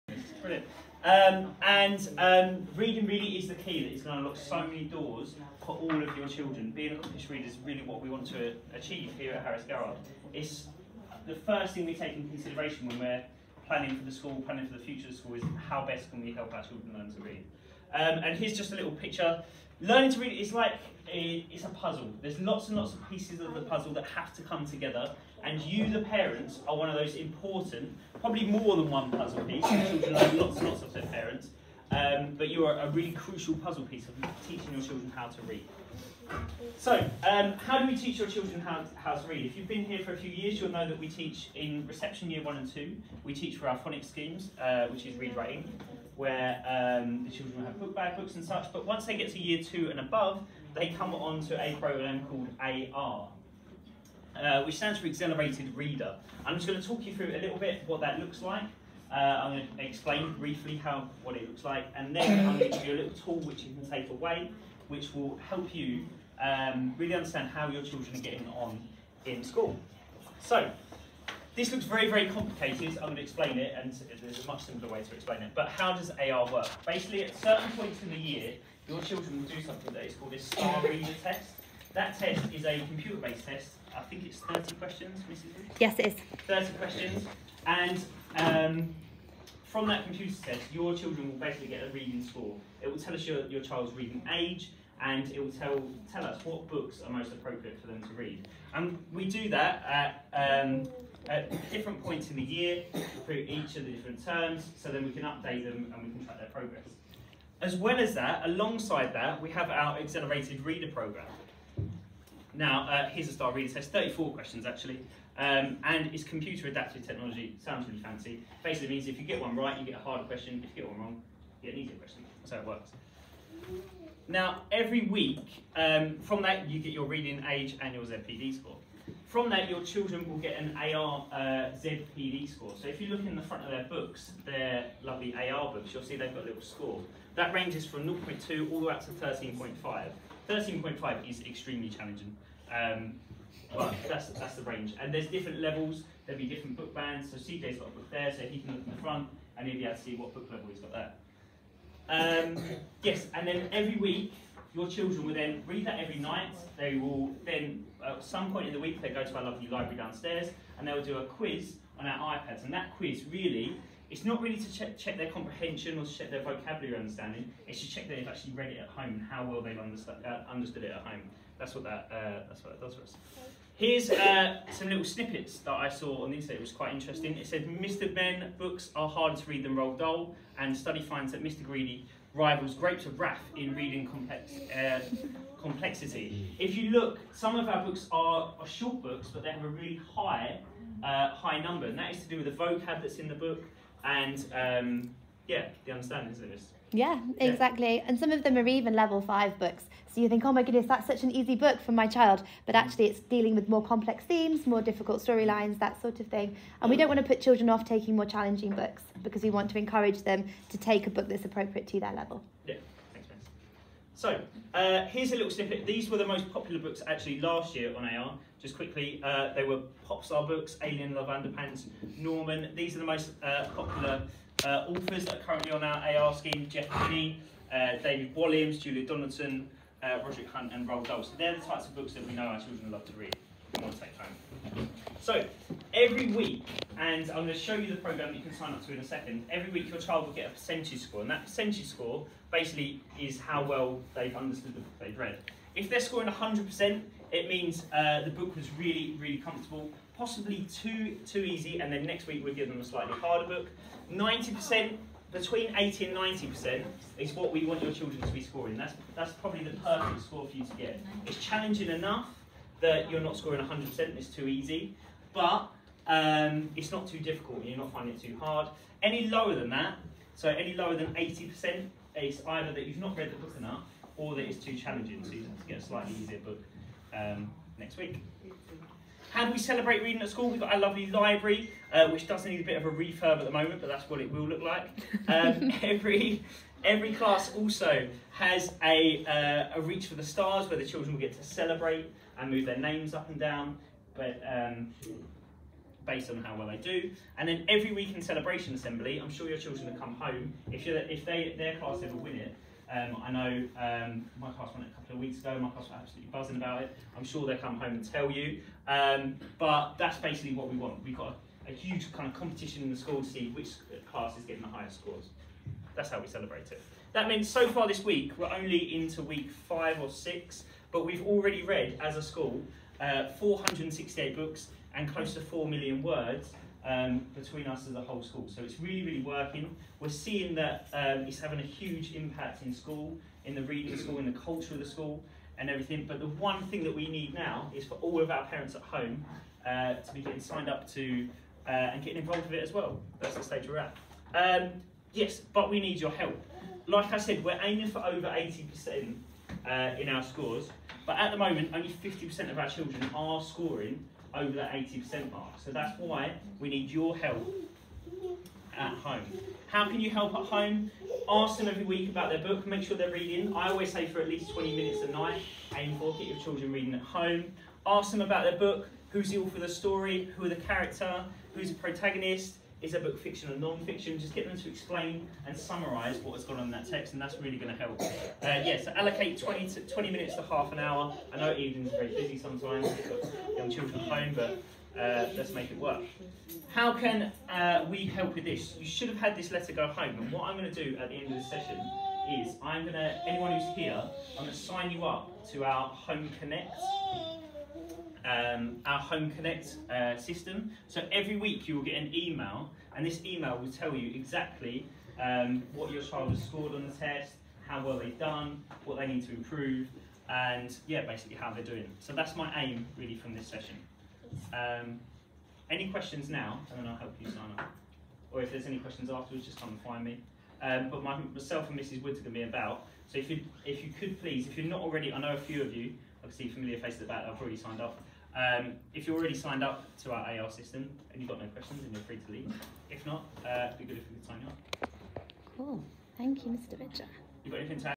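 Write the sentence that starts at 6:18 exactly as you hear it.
Uh, yeah, so allocate 20, to 20 minutes to half an hour.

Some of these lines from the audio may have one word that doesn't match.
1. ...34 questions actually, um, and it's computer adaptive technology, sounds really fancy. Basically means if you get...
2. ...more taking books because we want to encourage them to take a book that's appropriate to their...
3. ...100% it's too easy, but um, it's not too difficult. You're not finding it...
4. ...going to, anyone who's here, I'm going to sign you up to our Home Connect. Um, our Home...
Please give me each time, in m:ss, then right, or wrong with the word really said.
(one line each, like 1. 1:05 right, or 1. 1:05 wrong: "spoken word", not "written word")
1. 1:53 right
2. 3:28 wrong: "challenging", not "taking"
3. 4:23 right
4. 6:32 right.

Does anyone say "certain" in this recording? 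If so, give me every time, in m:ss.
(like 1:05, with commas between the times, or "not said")
1:17.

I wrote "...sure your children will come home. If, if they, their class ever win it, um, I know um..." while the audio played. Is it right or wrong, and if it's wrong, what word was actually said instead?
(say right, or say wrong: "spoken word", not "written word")
right.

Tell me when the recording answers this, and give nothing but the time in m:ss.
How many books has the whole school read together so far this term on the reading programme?
5:23.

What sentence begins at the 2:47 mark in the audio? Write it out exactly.
It's to check that they've actually read it at home and how well they've understood, uh, understood it at home.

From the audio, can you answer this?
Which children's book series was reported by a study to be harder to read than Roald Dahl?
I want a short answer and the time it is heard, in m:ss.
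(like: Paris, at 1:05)
Mr. Men, at 2:57.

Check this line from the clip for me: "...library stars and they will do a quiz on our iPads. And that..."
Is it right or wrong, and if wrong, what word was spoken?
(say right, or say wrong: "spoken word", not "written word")
wrong: "downstairs", not "stars".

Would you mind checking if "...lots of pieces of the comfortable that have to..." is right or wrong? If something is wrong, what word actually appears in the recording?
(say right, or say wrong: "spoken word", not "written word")
wrong: "puzzle", not "comfortable".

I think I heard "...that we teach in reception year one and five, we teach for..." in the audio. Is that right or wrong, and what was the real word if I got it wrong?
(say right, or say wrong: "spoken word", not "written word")
wrong: "two", not "five".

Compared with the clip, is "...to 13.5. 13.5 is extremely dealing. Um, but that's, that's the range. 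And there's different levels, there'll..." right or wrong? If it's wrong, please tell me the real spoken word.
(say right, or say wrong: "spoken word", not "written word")
wrong: "challenging", not "dealing".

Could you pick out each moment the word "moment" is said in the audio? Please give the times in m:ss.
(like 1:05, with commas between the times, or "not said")
4:43, 5:51.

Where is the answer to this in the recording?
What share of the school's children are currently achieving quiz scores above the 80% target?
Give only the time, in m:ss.
5:51.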